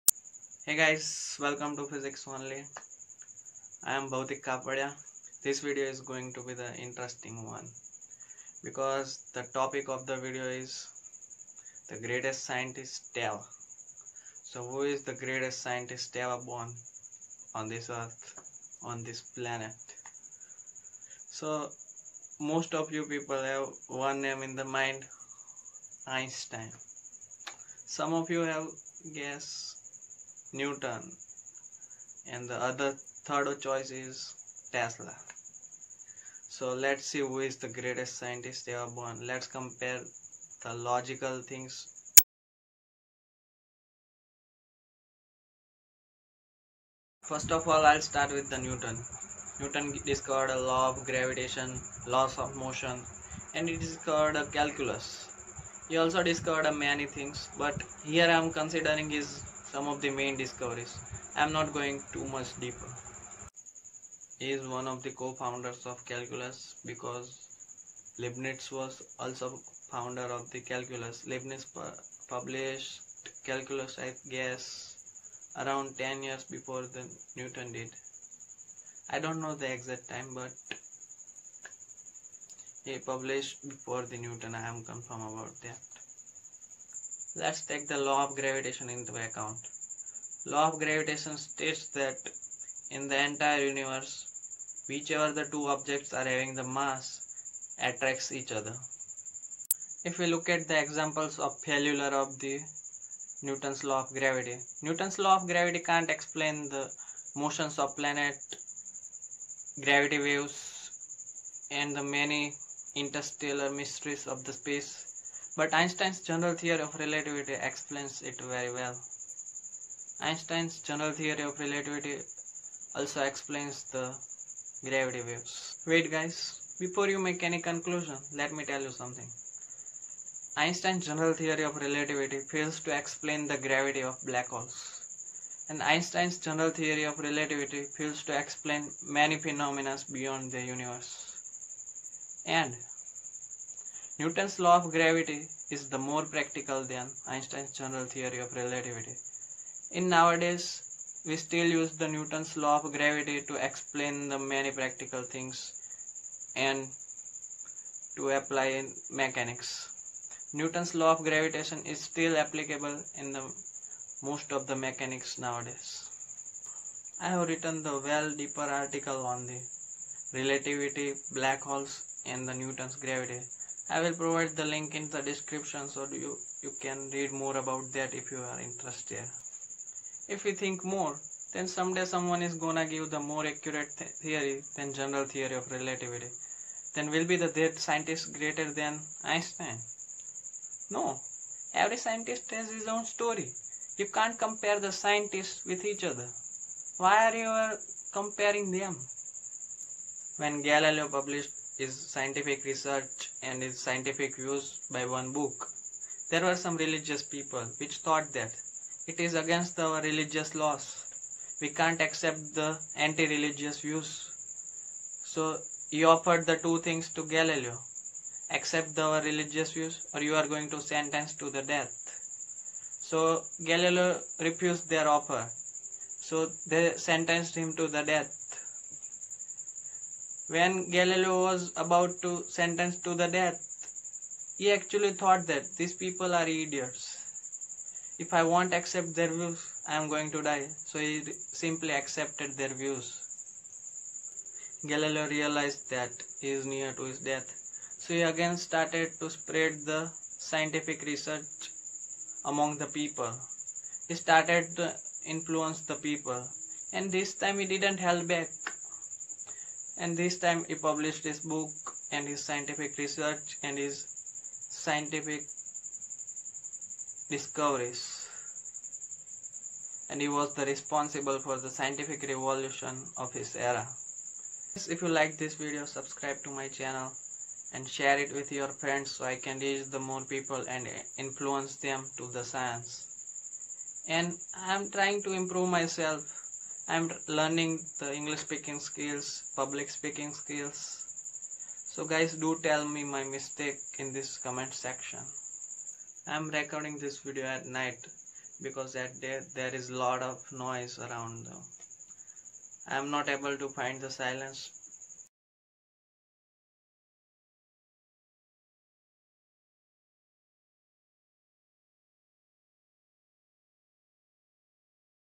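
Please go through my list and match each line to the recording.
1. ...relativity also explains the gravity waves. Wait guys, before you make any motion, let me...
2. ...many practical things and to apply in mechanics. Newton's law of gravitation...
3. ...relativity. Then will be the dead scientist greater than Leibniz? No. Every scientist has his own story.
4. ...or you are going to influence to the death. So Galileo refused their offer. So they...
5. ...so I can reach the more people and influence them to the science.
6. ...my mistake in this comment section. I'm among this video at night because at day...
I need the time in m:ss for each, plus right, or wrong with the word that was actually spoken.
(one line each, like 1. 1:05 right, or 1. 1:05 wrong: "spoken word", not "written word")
1. 2:01 wrong: "conclusion", not "motion"
2. 2:34 right
3. 3:05 wrong: "Einstein", not "Leibniz"
4. 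3:40 wrong: "sentence", not "influence"
5. 4:39 right
6. 4:53 wrong: "recording", not "among".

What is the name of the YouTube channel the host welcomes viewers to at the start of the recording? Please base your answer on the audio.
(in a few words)
Physics Only.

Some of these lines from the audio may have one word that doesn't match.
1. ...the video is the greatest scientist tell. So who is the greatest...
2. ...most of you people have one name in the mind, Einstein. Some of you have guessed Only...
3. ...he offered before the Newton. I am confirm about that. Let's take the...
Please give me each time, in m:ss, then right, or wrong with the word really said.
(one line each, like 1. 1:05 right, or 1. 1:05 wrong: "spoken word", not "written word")
1. 0:10 right
2. 0:22 wrong: "Newton", not "Only"
3. 1:22 wrong: "published", not "offered".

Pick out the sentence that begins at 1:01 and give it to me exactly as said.
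I am not going too much deeper.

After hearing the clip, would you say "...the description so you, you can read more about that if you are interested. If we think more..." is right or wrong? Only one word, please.
right.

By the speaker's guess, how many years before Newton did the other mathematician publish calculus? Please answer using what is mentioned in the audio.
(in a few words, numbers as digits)
10 years.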